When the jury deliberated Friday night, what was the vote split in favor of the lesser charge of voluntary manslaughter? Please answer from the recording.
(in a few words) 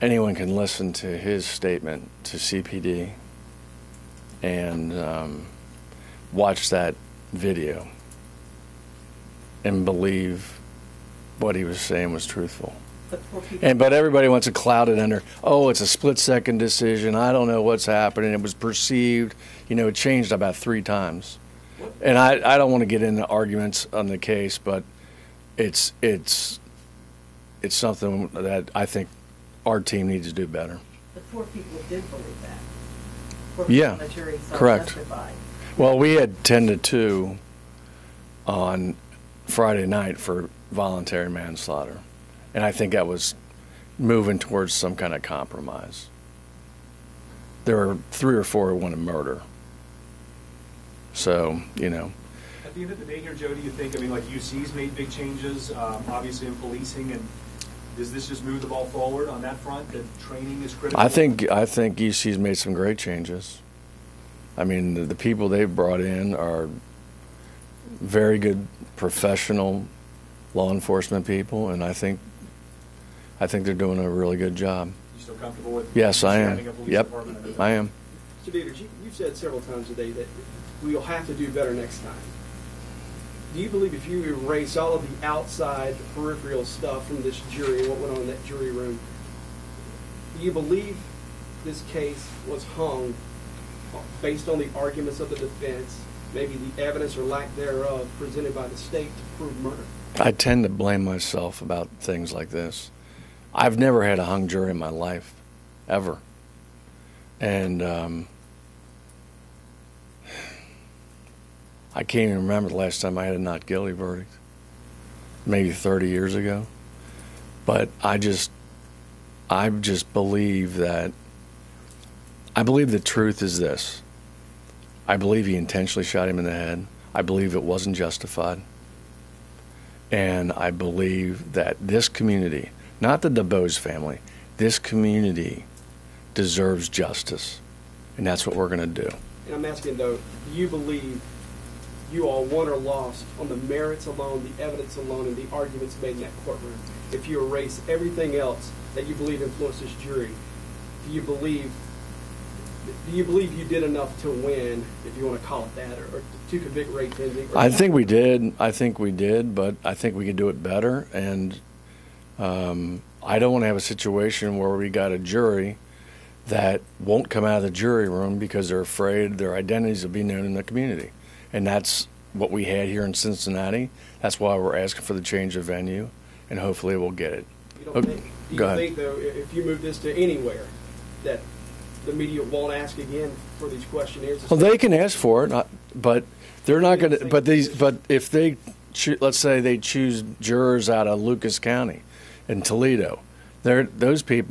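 10 to 2.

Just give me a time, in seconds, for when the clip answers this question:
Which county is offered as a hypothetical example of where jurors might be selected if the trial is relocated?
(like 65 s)
191 s.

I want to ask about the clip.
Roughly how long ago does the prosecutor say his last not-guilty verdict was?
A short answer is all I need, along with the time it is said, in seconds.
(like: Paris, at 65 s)
30 years ago, at 115 s.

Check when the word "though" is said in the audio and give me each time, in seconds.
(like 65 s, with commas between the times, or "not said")
139 s, 178 s.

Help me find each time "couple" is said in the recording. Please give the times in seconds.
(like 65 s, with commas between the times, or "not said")
not said.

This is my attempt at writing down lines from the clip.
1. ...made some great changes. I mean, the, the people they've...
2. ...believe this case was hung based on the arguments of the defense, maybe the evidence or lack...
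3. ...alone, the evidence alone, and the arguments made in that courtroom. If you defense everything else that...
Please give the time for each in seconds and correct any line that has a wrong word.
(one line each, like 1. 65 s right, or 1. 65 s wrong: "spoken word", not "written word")
1. 62 s right
2. 90 s right
3. 144 s wrong: "erase", not "defense".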